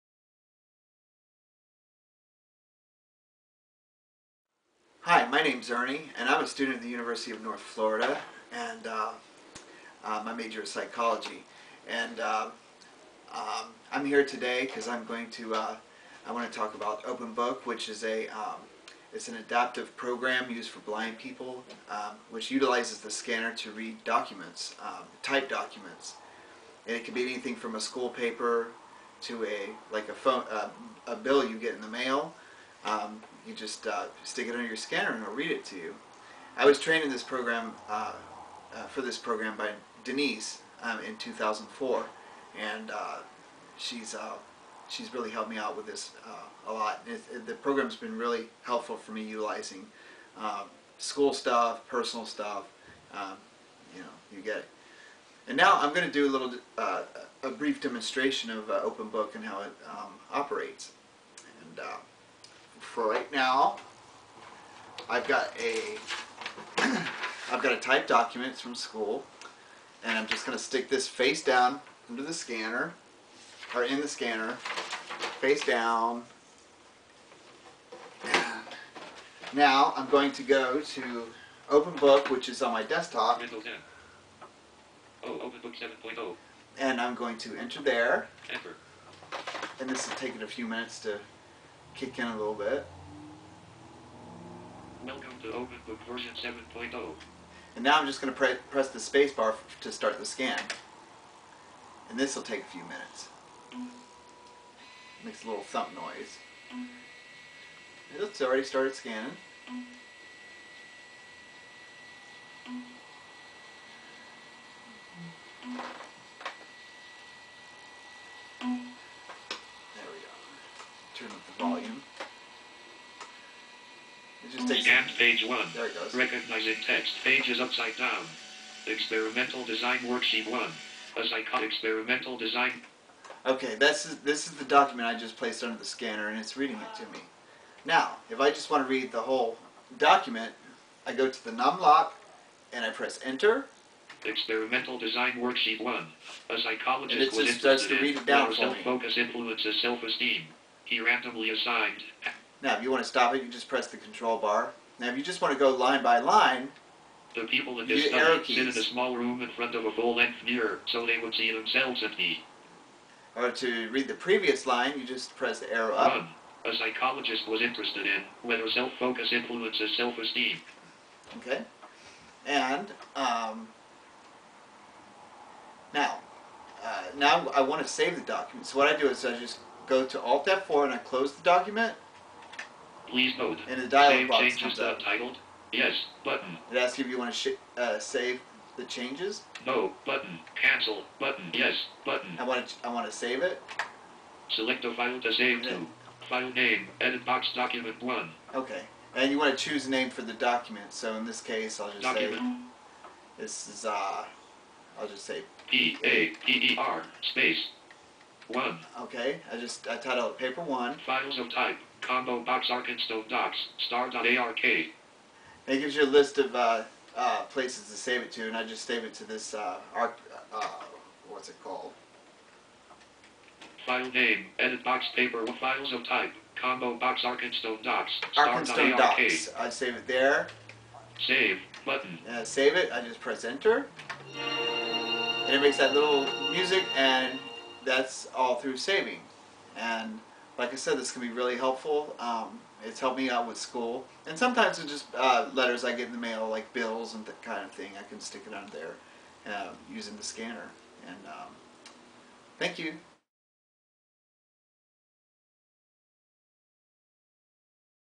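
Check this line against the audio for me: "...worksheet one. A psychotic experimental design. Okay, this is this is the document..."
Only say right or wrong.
right.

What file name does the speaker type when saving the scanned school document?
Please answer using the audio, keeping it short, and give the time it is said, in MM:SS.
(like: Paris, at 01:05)
paper one, at 03:30.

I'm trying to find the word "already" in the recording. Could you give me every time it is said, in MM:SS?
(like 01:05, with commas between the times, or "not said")
01:48.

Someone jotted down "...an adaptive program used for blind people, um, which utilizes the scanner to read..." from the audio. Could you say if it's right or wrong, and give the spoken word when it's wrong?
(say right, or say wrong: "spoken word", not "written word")
right.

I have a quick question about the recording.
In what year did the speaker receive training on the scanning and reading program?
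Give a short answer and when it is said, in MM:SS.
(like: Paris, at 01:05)
2004, at 00:41.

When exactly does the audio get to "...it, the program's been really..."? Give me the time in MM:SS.
00:47.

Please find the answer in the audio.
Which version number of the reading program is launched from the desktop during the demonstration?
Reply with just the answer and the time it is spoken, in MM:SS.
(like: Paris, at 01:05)
7.0, at 01:25.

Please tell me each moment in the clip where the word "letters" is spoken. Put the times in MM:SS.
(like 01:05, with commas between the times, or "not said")
04:05.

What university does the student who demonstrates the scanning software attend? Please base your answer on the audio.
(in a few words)
University of North Florida.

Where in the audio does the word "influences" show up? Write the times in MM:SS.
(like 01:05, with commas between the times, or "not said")
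02:29, 02:49.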